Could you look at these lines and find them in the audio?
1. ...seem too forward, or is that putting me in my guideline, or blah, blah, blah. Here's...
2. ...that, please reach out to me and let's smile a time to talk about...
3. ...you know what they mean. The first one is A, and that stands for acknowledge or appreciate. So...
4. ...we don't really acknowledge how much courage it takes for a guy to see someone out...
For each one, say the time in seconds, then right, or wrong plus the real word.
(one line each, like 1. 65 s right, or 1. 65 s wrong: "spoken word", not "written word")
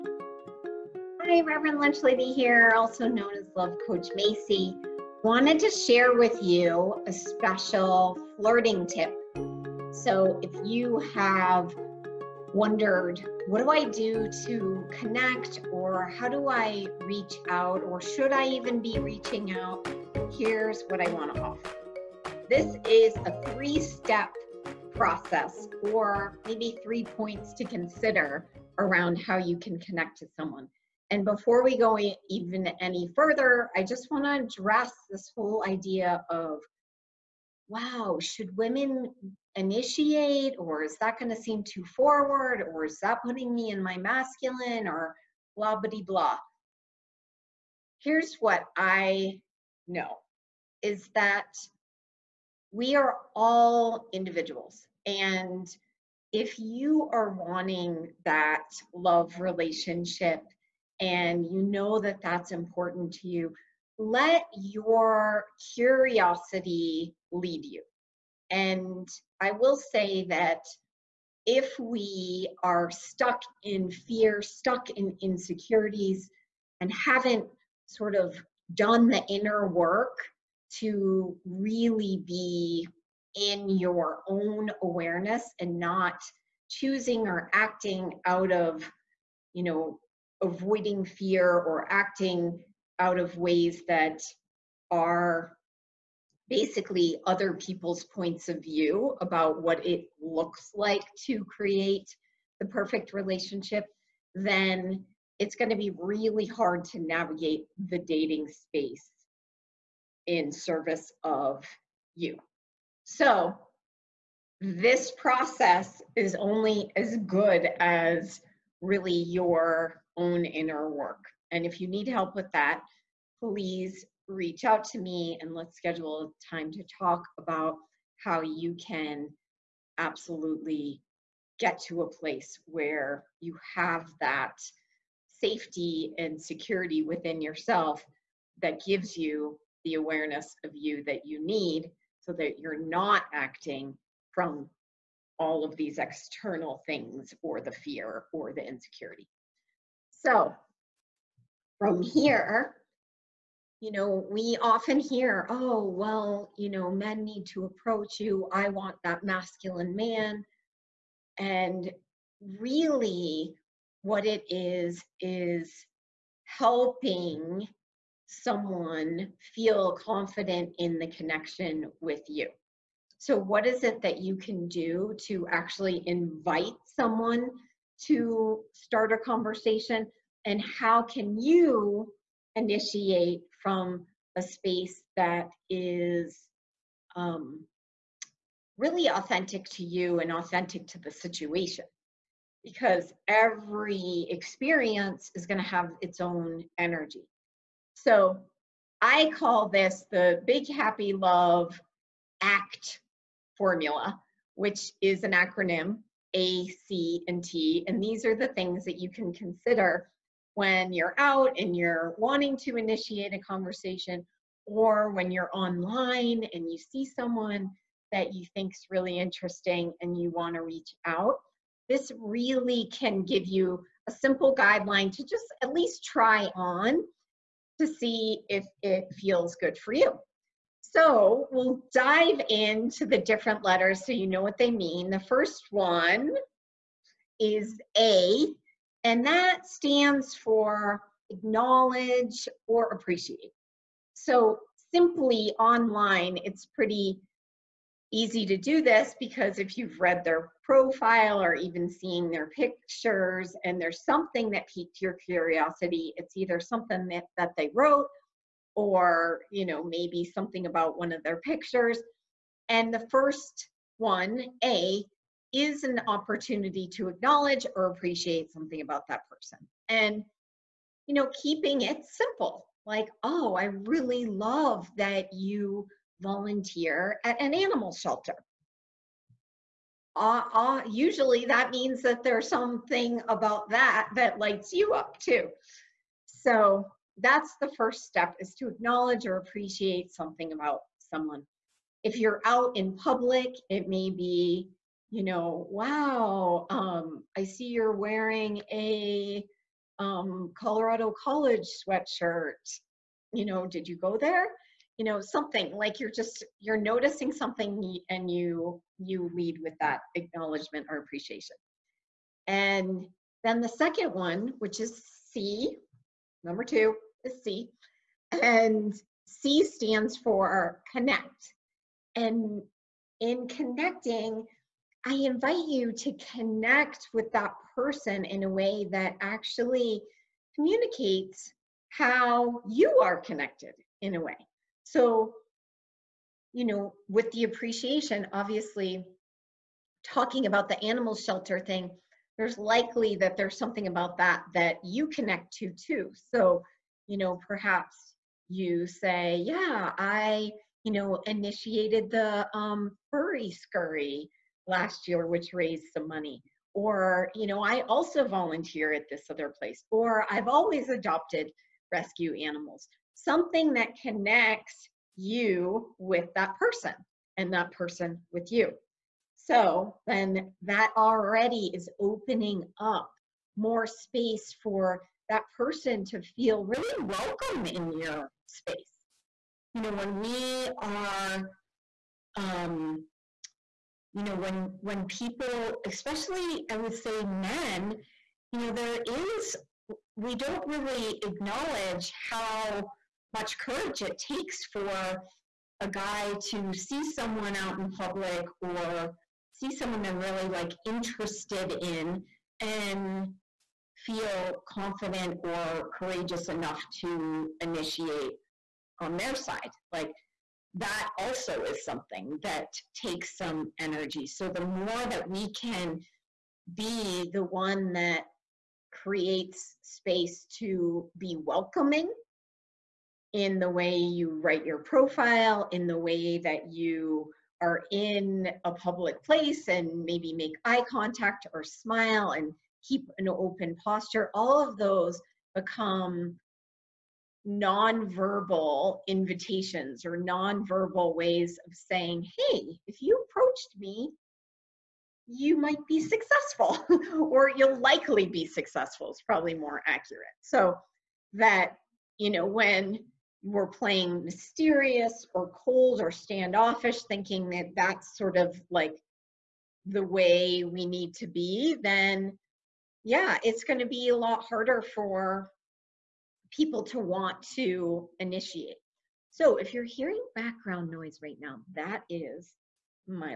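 1. 41 s wrong: "masculine", not "guideline"
2. 122 s wrong: "schedule", not "smile"
3. 234 s right
4. 390 s right.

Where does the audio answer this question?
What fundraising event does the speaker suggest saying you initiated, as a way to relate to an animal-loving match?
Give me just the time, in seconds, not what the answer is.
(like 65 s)
353 s.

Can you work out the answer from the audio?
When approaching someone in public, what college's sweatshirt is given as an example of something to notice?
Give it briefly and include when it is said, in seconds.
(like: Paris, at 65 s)
Colorado College, at 300 s.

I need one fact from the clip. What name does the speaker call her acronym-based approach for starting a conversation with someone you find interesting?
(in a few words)
big happy love act formula.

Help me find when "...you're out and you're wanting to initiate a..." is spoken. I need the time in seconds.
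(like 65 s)
210 s.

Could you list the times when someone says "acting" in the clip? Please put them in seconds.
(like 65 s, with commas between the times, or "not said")
87 s, 91 s, 143 s.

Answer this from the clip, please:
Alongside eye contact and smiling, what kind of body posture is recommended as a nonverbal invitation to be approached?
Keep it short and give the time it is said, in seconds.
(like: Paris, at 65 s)
open posture, at 433 s.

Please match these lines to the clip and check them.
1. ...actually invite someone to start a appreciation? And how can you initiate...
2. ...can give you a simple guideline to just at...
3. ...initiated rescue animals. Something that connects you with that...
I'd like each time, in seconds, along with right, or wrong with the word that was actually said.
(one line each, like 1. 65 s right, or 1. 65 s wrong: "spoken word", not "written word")
1. 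175 s wrong: "conversation", not "appreciation"
2. 222 s right
3. 360 s wrong: "adopted", not "initiated".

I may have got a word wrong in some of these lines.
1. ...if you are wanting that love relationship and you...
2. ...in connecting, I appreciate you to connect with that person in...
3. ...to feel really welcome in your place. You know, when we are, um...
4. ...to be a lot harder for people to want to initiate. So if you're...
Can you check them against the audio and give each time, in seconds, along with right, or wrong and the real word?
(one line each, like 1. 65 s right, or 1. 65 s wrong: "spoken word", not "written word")
1. 56 s right
2. 323 s wrong: "invite", not "appreciate"
3. 376 s wrong: "space", not "place"
4. 463 s right.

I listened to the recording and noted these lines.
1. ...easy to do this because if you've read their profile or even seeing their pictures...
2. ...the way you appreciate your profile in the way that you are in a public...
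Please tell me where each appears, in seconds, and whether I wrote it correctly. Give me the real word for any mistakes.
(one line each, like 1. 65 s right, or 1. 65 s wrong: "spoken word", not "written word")
1. 248 s right
2. 423 s wrong: "write", not "appreciate".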